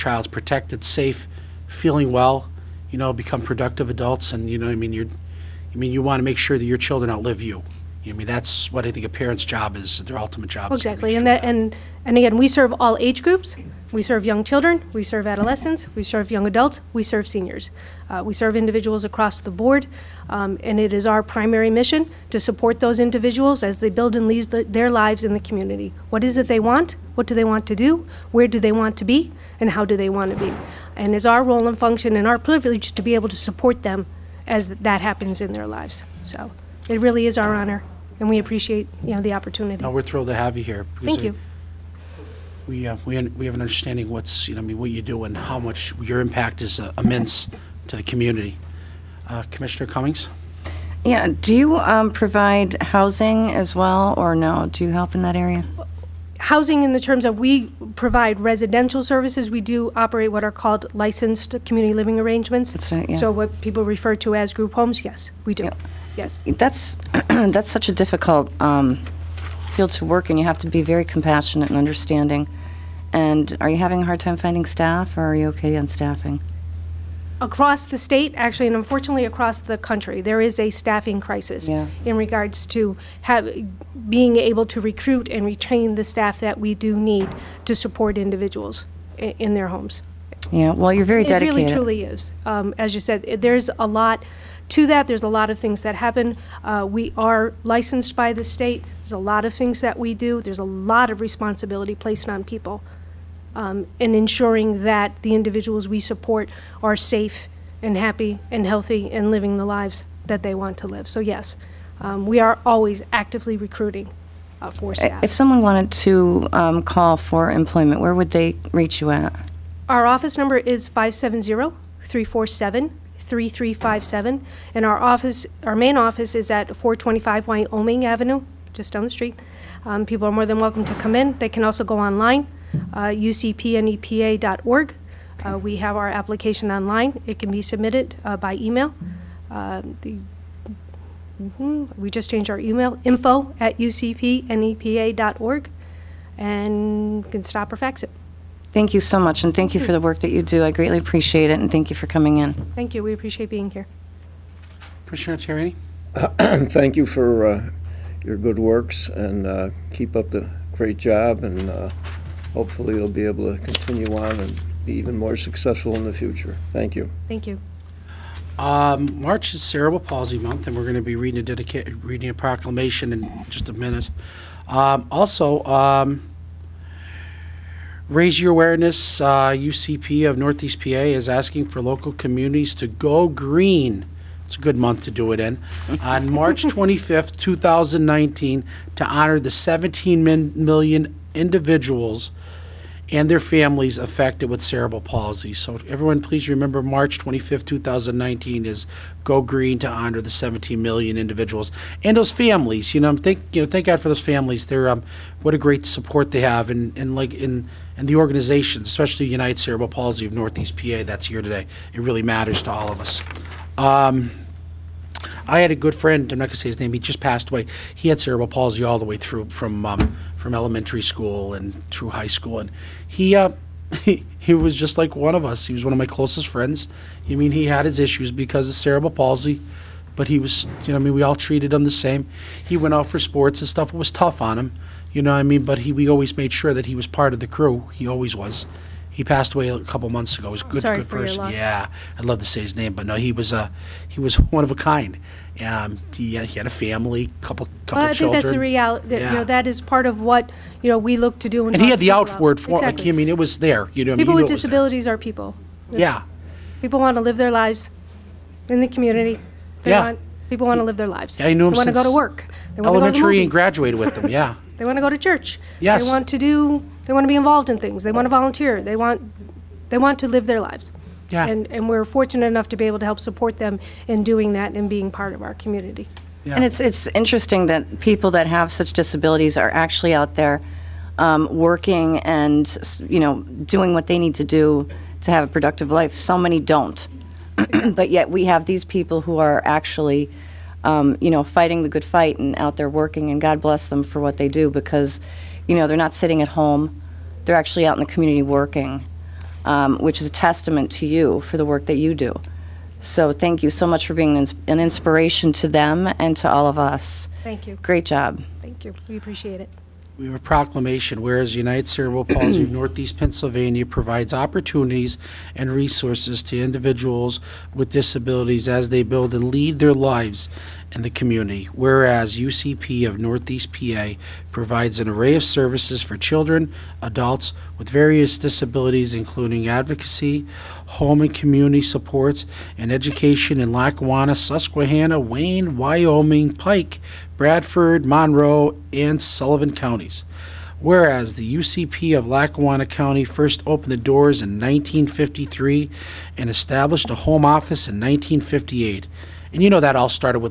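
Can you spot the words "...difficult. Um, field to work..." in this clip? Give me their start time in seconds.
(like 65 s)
67 s.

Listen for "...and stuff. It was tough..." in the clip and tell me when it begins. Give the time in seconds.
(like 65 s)
233 s.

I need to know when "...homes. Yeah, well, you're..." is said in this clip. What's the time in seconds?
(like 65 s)
89 s.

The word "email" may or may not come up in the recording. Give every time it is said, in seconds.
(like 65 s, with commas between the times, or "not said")
138 s, 142 s.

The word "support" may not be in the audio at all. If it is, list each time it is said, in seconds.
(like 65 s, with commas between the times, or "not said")
22 s, 33 s, 87 s, 105 s, 205 s, 273 s, 331 s.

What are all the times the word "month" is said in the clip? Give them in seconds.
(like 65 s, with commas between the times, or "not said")
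170 s, 184 s, 240 s.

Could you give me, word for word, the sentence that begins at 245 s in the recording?
Um, he, had, he had a family, couple couple well, I children.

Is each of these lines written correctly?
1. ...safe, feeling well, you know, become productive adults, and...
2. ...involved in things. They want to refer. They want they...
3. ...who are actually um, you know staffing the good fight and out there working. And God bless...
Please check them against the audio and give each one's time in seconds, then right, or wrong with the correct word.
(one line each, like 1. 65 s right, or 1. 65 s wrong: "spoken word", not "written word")
1. 0 s right
2. 267 s wrong: "volunteer", not "refer"
3. 289 s wrong: "fighting", not "staffing".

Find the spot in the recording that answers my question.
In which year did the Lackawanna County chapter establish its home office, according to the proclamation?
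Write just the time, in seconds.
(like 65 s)
347 s.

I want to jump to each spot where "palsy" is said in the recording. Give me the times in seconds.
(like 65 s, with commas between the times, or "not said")
170 s, 195 s, 209 s, 218 s, 229 s, 312 s.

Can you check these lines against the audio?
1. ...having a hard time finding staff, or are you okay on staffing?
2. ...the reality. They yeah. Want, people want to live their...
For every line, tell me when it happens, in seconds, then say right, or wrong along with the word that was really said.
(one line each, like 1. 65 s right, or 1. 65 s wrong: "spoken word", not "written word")
1. 73 s right
2. 258 s wrong: "community", not "reality".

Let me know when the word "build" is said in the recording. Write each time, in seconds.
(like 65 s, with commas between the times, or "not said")
23 s, 319 s.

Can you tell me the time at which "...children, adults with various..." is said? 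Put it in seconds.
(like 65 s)
326 s.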